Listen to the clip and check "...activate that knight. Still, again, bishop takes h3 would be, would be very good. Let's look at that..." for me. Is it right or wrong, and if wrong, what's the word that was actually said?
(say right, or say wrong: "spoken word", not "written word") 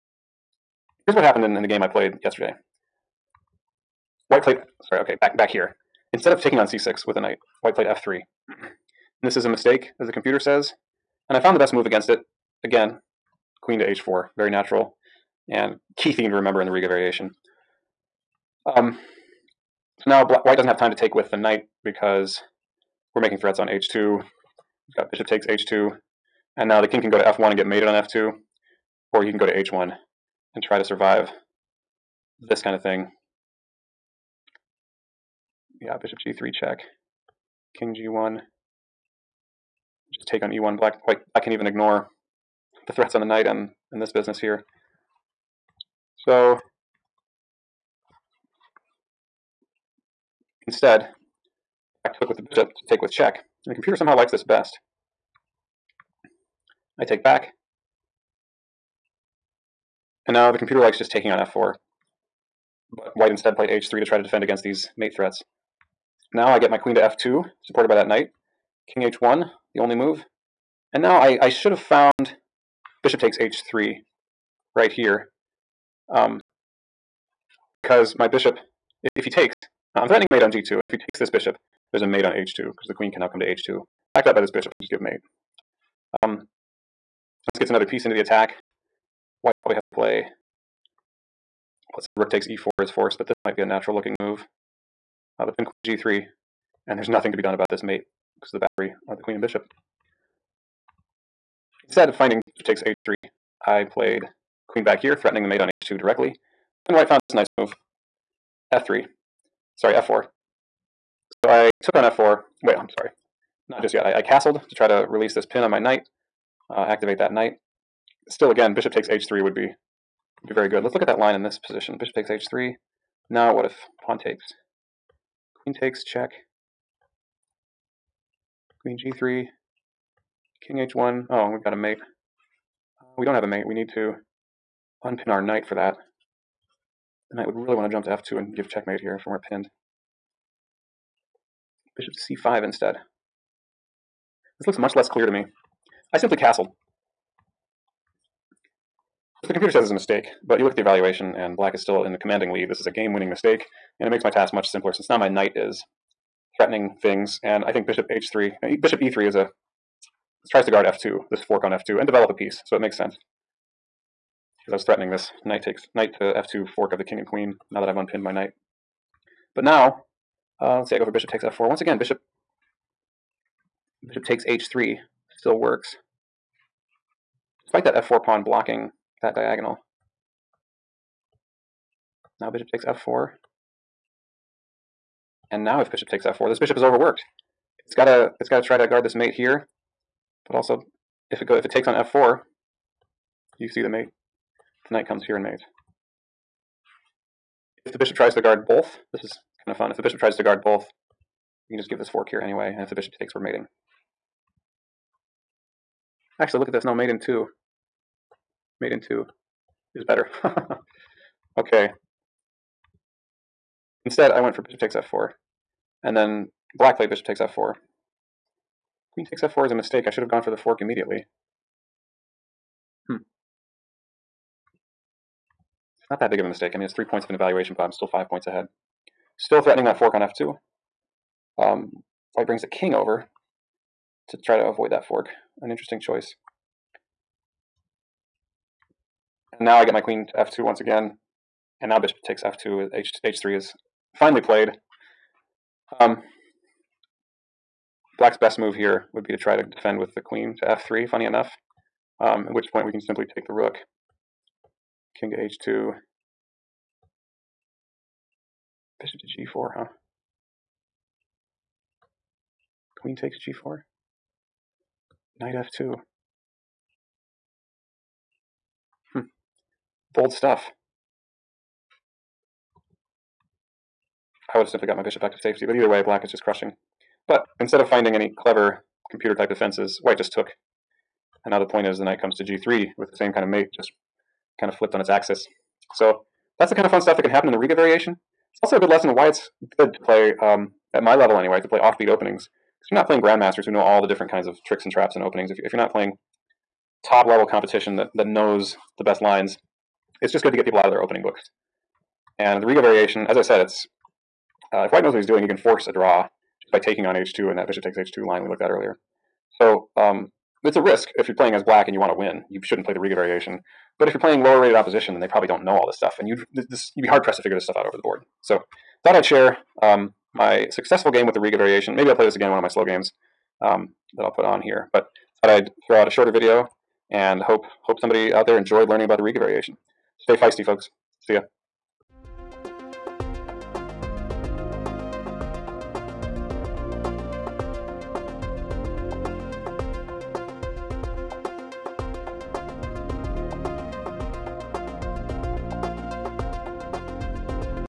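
right.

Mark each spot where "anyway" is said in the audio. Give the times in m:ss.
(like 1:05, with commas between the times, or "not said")
3:22, 4:51.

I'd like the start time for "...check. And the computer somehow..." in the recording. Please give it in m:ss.
0:53.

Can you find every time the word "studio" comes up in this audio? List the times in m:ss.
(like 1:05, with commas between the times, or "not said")
not said.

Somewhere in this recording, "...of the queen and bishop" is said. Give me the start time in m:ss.
1:39.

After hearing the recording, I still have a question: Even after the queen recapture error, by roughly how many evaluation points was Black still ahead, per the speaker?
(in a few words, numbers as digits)
5.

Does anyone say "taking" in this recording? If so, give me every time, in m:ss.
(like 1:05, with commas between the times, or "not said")
0:06, 1:01, 5:06.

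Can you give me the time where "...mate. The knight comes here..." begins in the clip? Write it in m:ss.
3:13.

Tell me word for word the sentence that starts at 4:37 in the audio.
But instead of finding any clever computer type defenses, white just took.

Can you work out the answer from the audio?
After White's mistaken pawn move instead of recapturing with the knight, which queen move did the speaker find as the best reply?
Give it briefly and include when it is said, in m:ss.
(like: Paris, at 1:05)
Queen to h4, at 0:13.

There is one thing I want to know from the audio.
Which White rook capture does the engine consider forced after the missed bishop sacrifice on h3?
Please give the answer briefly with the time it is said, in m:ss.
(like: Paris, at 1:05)
Rook takes e4, at 1:32.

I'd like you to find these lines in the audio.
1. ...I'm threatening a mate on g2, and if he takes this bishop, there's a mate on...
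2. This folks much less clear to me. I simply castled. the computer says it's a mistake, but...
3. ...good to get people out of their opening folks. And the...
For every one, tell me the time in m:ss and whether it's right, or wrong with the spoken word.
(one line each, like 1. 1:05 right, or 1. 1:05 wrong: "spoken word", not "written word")
1. 1:19 right
2. 2:24 wrong: "looks", not "folks"
3. 5:00 wrong: "books", not "folks".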